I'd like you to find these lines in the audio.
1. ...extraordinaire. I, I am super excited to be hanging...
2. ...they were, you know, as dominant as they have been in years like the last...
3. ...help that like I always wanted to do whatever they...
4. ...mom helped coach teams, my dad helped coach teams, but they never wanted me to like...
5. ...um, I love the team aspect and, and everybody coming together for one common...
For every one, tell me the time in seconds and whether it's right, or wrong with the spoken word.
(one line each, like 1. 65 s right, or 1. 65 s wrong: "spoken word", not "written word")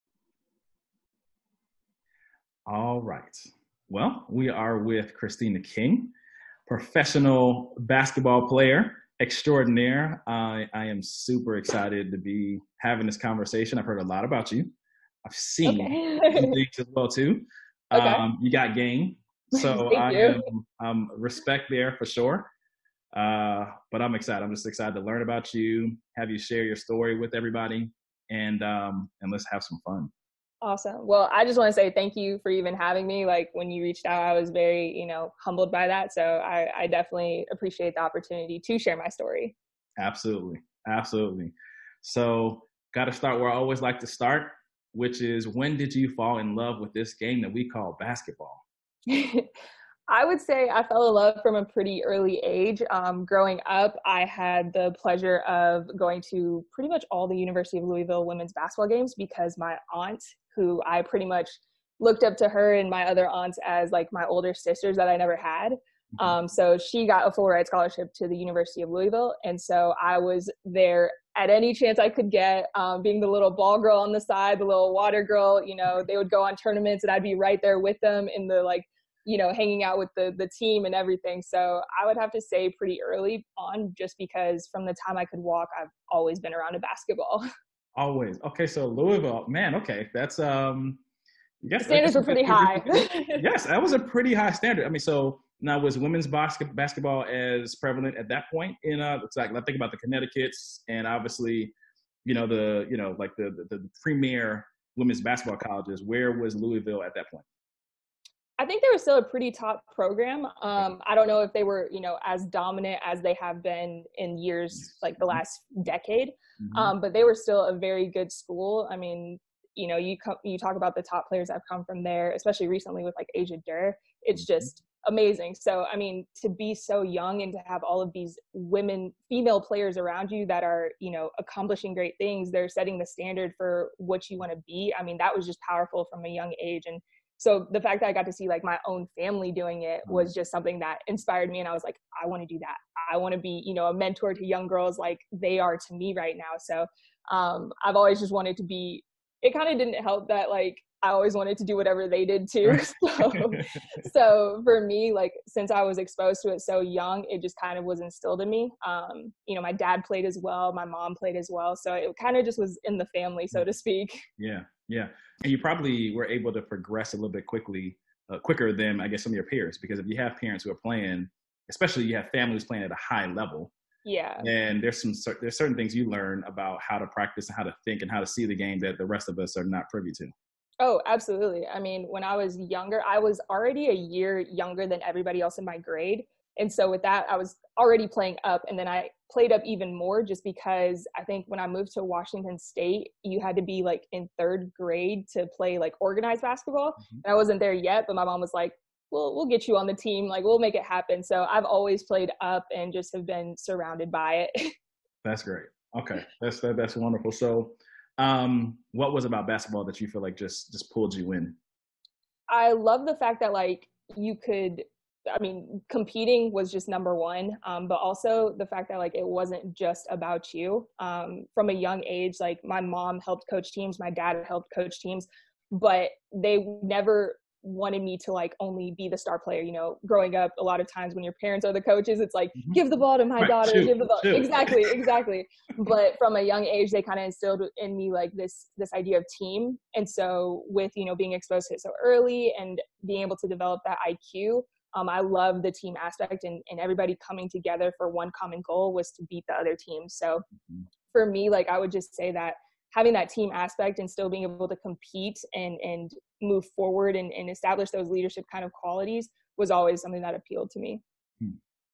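1. 9 s wrong: "having", not "hanging"
2. 111 s right
3. 150 s right
4. 222 s right
5. 244 s right.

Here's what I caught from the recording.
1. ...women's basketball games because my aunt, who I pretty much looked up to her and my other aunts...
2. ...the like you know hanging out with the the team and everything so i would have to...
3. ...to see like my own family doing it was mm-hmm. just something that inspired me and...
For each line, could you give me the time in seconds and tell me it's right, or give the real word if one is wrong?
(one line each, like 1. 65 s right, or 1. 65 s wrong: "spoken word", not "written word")
1. 58 s right
2. 78 s right
3. 138 s right.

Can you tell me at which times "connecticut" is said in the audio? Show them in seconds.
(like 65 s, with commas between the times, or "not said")
99 s.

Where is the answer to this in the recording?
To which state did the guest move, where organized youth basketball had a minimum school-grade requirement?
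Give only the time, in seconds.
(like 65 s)
192 s.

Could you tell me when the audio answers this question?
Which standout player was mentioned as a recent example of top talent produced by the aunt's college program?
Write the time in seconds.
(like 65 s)
123 s.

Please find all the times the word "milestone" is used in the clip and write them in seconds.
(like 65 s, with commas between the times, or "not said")
not said.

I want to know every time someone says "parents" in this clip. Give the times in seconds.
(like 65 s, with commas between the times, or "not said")
170 s, 231 s.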